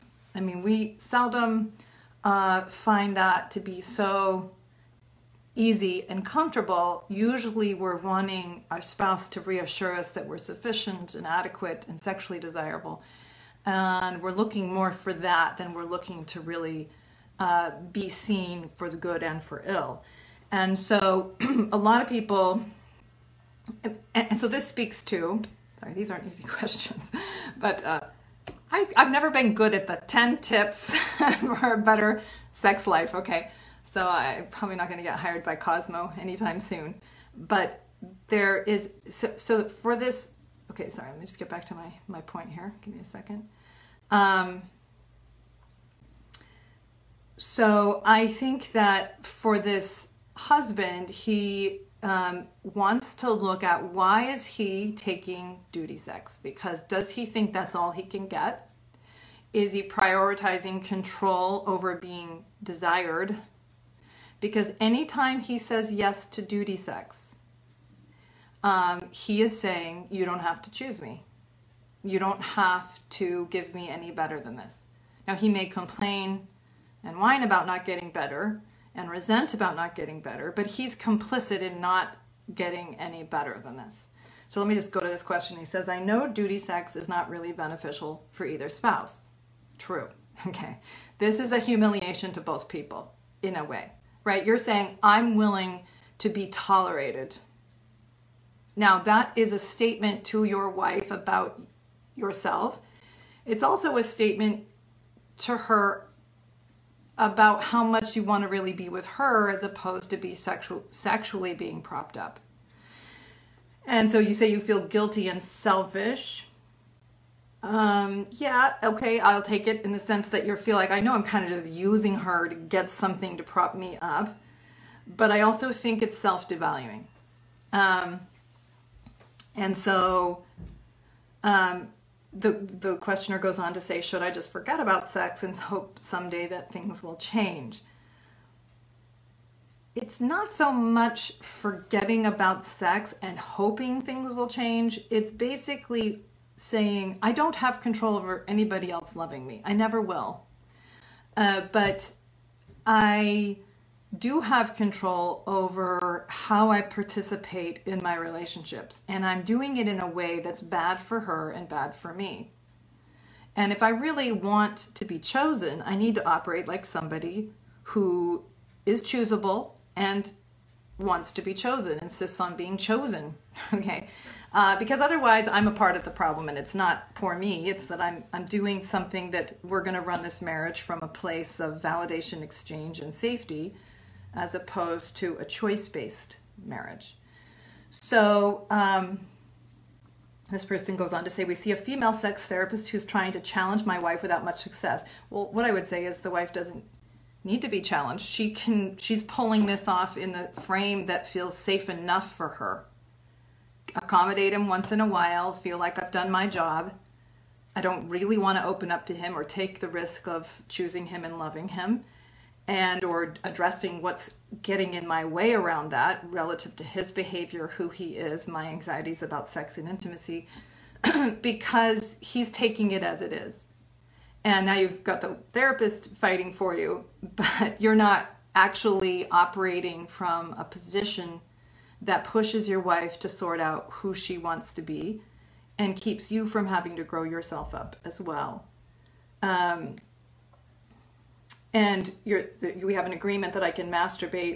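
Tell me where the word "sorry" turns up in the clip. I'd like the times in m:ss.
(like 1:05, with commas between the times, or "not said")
0:25, 0:40.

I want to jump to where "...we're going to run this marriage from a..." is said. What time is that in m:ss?
2:59.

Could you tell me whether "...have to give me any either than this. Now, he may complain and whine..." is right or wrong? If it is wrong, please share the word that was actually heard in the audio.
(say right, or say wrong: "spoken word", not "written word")
wrong: "better", not "either".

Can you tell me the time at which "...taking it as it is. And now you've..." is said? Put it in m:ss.
3:42.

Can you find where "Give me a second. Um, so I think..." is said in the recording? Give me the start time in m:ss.
0:42.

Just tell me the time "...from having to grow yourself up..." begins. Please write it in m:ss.
3:56.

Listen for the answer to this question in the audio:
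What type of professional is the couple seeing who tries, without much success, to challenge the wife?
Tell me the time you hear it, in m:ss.
3:12.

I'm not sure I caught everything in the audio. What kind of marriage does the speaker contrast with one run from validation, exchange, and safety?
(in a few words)
a choice-based marriage.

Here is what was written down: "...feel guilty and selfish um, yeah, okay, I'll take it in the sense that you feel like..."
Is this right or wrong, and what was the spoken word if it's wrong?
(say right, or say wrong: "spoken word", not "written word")
right.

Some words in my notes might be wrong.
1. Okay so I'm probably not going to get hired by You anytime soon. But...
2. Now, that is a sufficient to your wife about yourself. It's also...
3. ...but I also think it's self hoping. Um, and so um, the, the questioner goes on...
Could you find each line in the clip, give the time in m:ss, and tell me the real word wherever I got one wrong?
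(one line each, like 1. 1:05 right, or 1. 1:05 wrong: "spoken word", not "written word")
1. 0:33 wrong: "Cosmo", not "You"
2. 1:38 wrong: "statement", not "sufficient"
3. 2:05 wrong: "devaluing", not "hoping".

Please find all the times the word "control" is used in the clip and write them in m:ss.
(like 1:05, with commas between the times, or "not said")
1:00, 2:27, 2:34.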